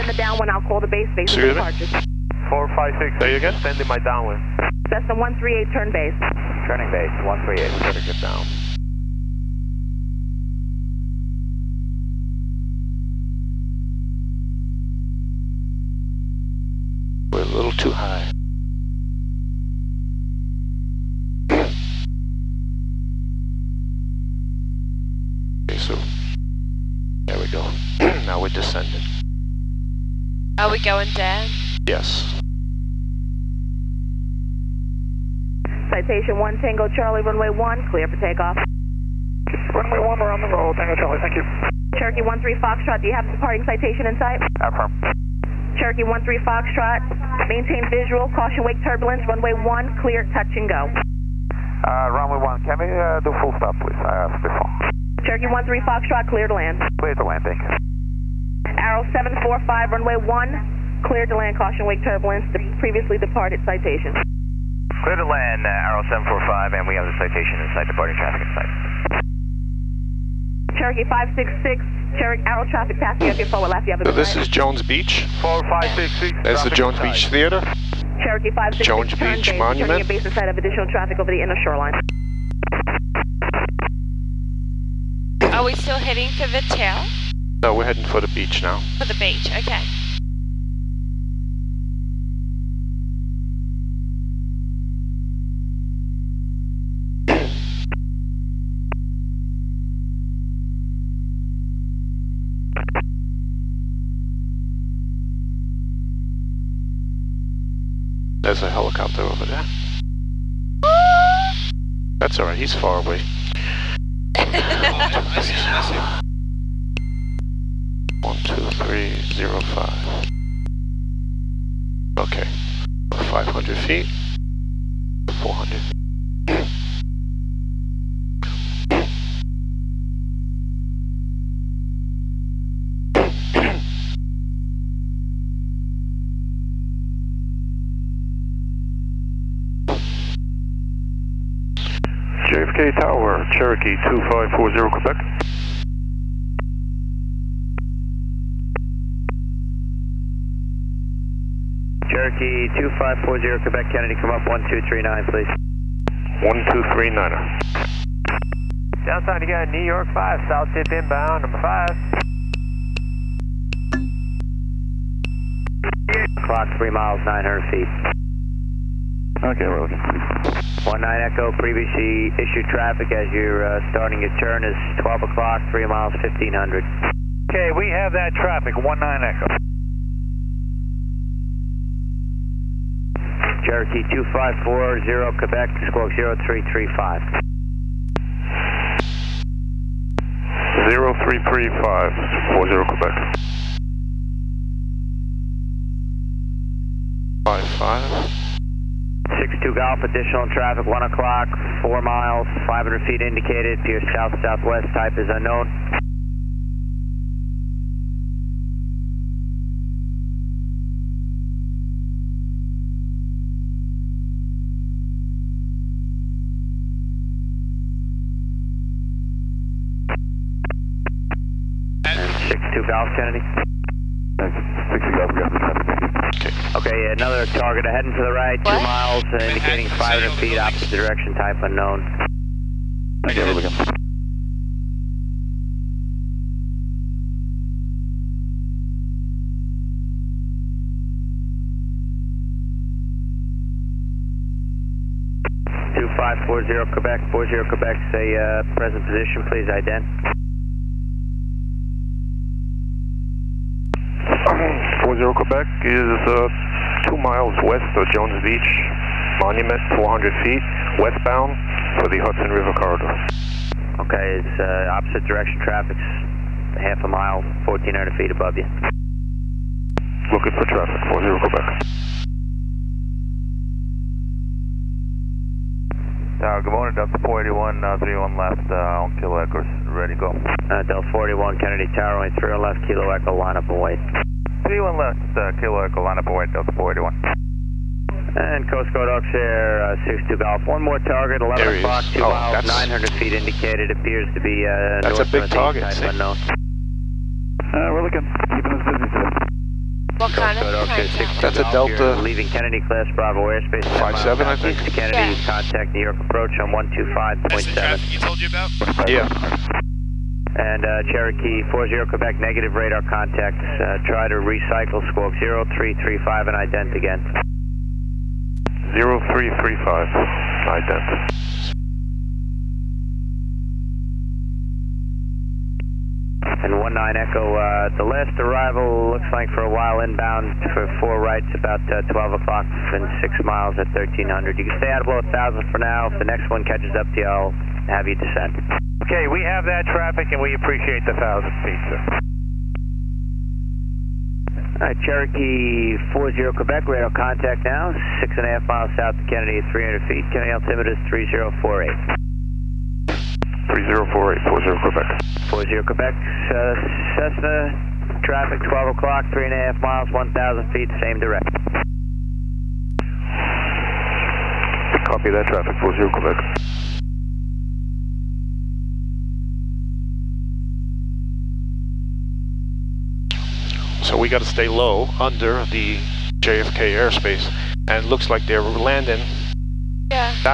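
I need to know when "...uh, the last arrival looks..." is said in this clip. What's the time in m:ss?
5:27.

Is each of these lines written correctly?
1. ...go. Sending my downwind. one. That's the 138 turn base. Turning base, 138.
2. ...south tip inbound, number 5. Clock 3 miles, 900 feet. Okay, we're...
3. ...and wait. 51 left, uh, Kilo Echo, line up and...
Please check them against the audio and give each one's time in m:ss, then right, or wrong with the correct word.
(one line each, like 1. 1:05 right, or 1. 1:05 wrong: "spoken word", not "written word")
1. 0:03 right
2. 2:40 right
3. 4:43 wrong: "31", not "51".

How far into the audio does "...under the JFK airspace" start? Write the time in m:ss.
6:15.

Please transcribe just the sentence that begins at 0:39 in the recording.
Runway 1, we're on the roll.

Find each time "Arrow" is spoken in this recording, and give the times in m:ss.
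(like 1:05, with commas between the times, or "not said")
0:58, 1:05, 1:12.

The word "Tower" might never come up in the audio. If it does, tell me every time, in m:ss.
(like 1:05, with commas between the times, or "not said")
2:23, 4:36, 4:41.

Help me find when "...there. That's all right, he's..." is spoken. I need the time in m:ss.
1:49.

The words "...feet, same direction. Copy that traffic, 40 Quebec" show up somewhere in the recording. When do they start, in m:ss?
6:00.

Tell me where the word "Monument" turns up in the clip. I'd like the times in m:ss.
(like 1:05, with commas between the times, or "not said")
1:19, 4:19.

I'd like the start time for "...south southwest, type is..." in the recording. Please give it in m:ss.
3:24.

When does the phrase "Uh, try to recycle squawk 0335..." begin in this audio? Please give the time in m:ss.
5:13.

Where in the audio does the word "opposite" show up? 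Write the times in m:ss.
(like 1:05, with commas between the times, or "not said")
3:50, 4:24.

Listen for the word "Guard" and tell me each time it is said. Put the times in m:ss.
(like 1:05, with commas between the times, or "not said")
4:48.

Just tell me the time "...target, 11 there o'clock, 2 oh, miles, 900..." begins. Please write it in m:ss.
4:51.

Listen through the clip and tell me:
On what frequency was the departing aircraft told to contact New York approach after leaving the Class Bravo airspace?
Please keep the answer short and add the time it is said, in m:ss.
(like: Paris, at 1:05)
125.7, at 5:06.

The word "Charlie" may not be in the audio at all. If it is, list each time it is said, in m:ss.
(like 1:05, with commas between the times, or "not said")
0:36, 0:40.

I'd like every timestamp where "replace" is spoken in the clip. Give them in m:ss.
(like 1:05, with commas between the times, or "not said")
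not said.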